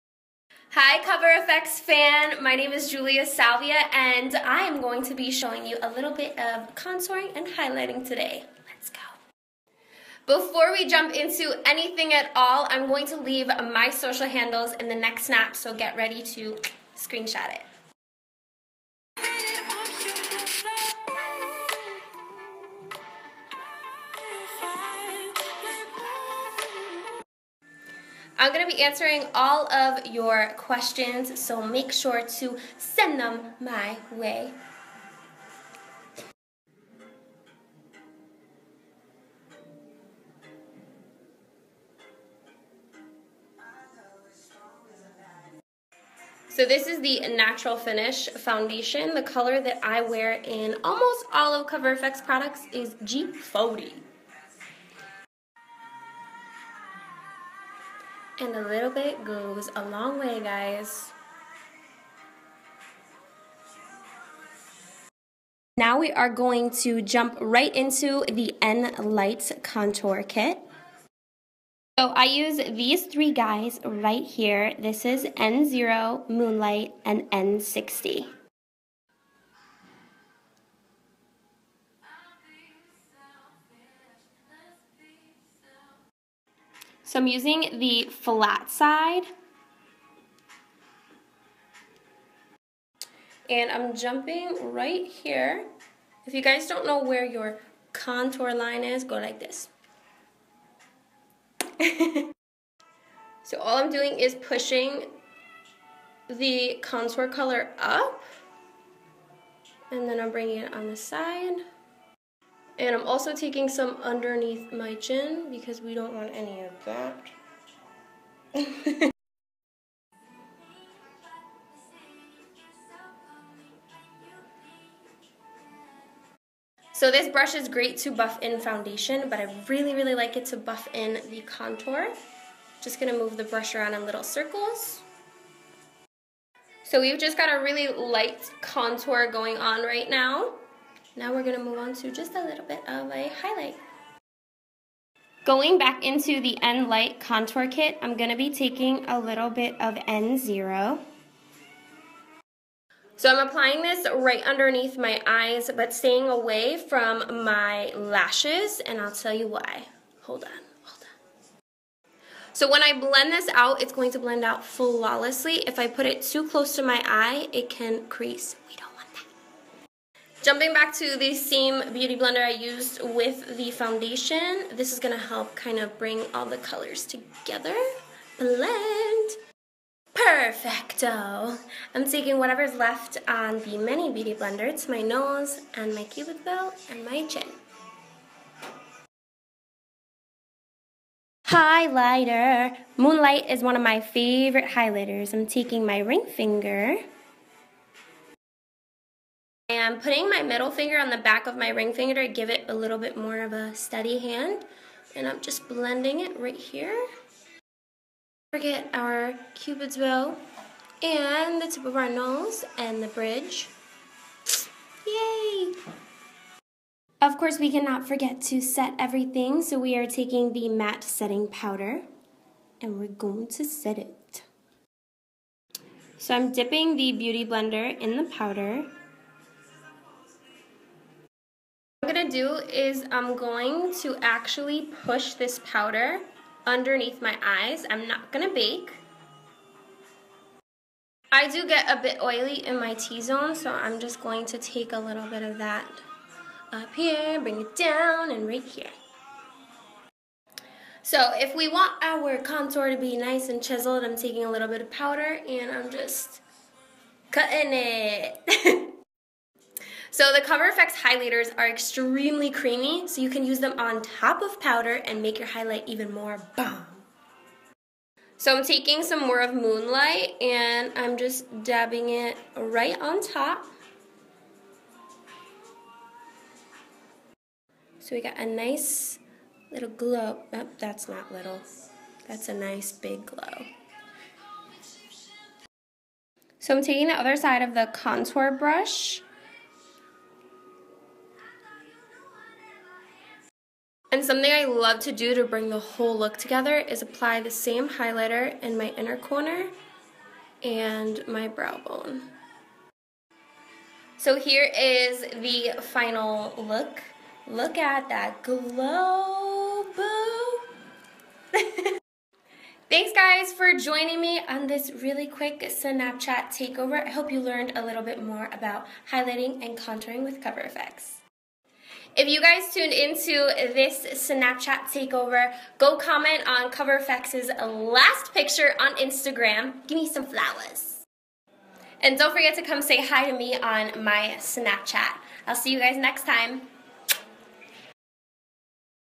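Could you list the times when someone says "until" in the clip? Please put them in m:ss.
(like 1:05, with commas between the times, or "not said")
not said.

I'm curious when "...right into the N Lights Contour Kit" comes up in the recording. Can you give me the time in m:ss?
1:07.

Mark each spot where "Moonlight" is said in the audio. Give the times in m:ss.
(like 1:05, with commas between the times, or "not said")
1:16, 3:12, 4:29.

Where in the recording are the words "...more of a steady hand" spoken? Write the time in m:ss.
3:23.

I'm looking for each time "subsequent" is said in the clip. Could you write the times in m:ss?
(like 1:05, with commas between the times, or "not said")
not said.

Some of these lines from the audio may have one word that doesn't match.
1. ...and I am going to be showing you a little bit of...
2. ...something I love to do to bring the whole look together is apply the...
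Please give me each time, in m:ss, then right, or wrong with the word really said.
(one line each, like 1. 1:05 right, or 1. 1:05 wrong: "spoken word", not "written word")
1. 0:03 right
2. 4:54 right.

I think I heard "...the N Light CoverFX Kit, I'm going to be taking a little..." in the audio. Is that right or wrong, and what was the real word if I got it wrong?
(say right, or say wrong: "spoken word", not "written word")
wrong: "Contour", not "CoverFX".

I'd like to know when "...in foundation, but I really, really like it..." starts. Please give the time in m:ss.
2:08.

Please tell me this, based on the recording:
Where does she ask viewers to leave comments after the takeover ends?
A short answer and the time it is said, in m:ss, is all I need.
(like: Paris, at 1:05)
Instagram, at 5:28.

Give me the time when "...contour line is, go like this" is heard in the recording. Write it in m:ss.
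1:37.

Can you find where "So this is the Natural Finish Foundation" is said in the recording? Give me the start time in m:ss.
0:46.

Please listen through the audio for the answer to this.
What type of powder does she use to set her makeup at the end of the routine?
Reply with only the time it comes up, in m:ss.
3:40.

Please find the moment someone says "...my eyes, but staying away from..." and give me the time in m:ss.
2:34.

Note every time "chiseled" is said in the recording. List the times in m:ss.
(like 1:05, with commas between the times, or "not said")
4:13.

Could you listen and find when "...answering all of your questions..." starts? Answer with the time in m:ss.
0:28.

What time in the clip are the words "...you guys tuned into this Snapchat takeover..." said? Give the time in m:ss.
5:22.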